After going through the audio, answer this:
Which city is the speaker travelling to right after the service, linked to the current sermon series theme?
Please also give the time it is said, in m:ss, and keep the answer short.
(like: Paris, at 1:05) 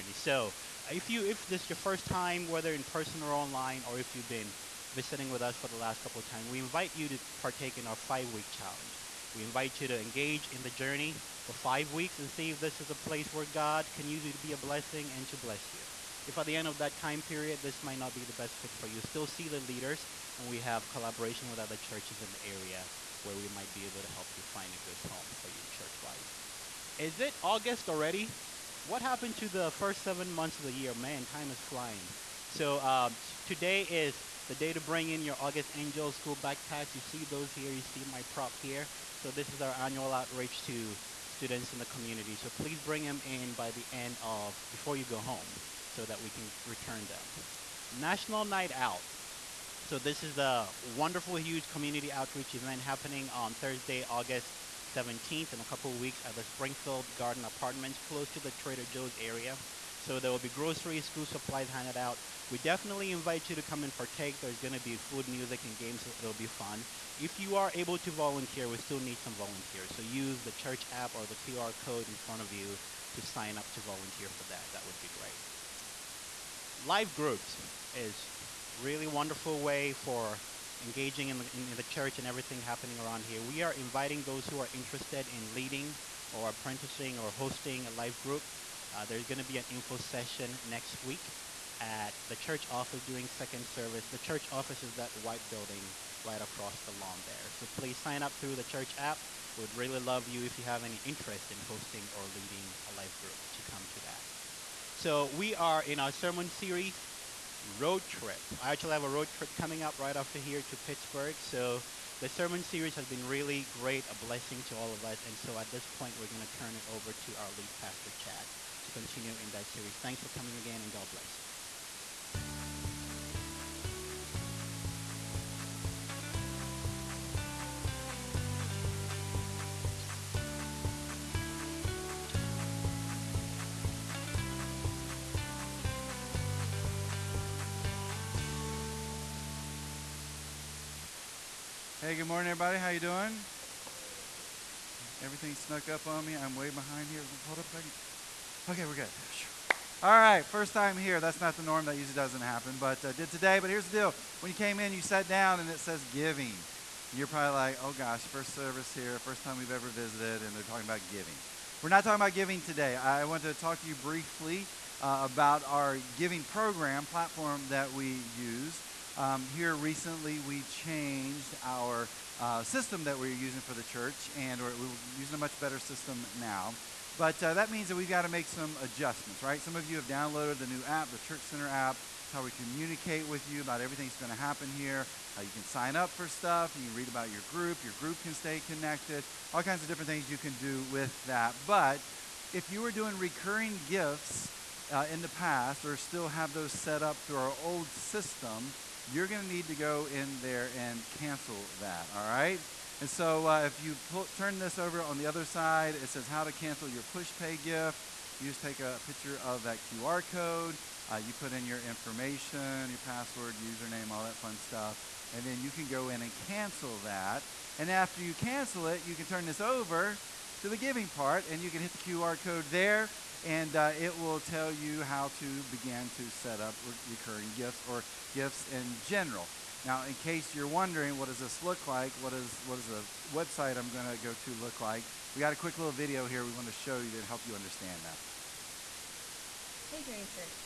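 Pittsburgh, at 1:50.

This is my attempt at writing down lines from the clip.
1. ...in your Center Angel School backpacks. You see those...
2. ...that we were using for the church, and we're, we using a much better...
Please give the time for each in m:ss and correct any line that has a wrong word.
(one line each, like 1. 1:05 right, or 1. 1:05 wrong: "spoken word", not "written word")
1. 0:35 wrong: "August", not "Center"
2. 2:53 right.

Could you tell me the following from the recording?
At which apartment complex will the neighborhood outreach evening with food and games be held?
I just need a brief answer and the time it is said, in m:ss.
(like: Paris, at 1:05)
Springfield Garden Apartments, at 0:56.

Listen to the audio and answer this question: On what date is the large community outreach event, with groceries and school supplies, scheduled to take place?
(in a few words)
Thursday, August 17th.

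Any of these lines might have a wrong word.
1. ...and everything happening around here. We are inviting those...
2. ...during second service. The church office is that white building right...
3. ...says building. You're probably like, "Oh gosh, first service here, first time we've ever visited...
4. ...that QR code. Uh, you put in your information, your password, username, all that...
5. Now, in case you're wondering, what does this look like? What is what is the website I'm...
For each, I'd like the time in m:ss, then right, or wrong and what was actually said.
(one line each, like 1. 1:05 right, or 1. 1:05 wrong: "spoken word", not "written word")
1. 1:22 right
2. 1:33 right
3. 2:35 wrong: "giving", not "building"
4. 3:29 right
5. 3:49 right.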